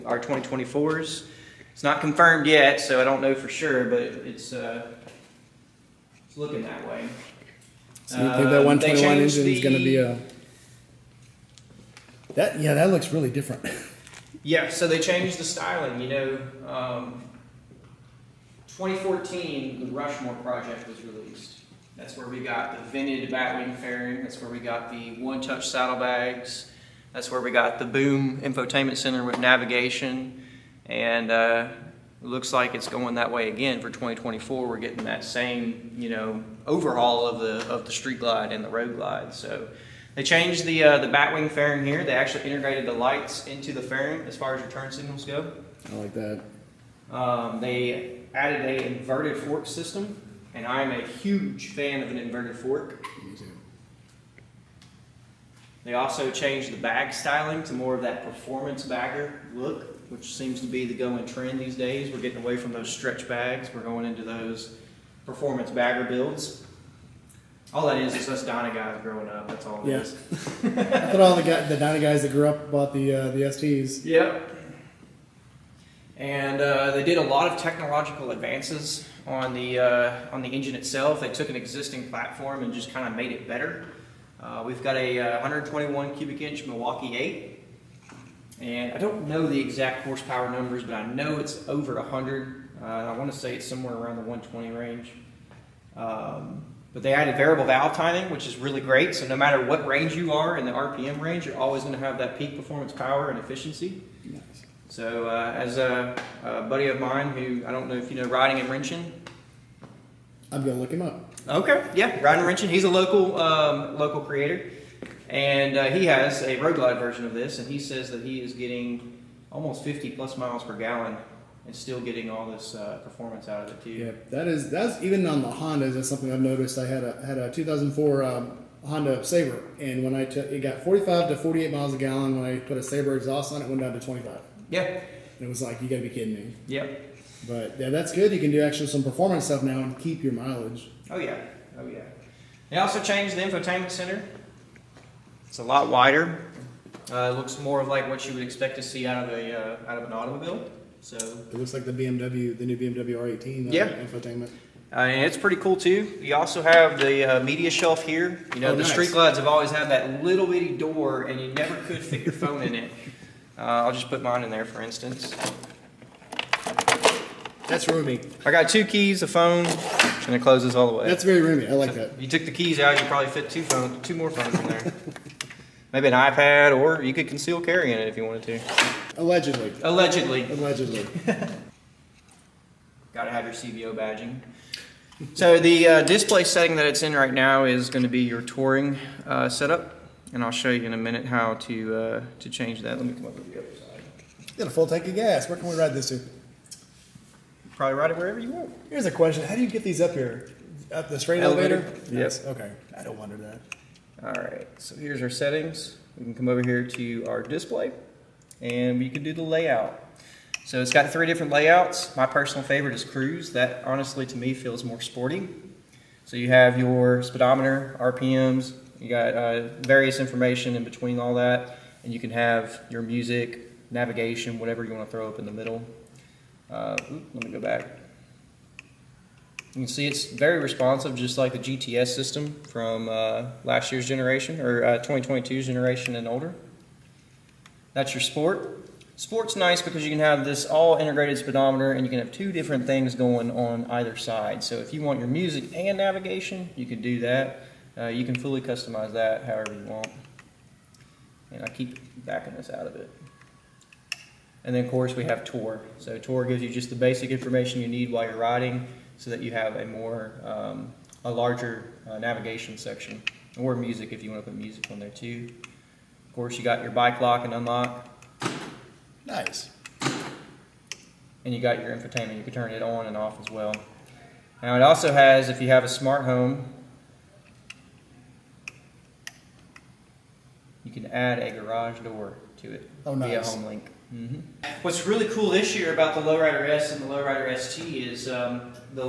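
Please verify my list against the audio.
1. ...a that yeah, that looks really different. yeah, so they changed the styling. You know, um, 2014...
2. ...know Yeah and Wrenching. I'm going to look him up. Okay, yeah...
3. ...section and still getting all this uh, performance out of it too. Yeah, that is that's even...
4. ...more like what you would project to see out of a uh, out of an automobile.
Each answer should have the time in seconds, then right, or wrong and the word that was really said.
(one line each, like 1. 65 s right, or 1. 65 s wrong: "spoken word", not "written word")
1. 9 s right
2. 108 s wrong: "Riding", not "Yeah"
3. 120 s wrong: "gallon", not "section"
4. 147 s wrong: "expect", not "project".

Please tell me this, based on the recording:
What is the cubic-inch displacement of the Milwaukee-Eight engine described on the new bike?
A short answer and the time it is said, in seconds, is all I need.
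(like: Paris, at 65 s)
121, at 85 s.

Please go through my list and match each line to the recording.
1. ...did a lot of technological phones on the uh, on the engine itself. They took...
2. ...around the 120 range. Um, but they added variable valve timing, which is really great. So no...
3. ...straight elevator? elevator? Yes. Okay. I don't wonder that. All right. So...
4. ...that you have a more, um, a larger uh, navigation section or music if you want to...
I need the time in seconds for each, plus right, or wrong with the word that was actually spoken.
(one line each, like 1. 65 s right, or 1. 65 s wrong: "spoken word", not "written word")
1. 77 s wrong: "advances", not "phones"
2. 93 s right
3. 201 s right
4. 259 s right.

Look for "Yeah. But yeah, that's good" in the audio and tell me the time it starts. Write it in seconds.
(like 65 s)
136 s.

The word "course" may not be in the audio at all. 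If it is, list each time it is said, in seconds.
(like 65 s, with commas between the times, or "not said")
254 s, 266 s.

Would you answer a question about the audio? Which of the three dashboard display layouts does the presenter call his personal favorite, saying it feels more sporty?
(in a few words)
Cruise.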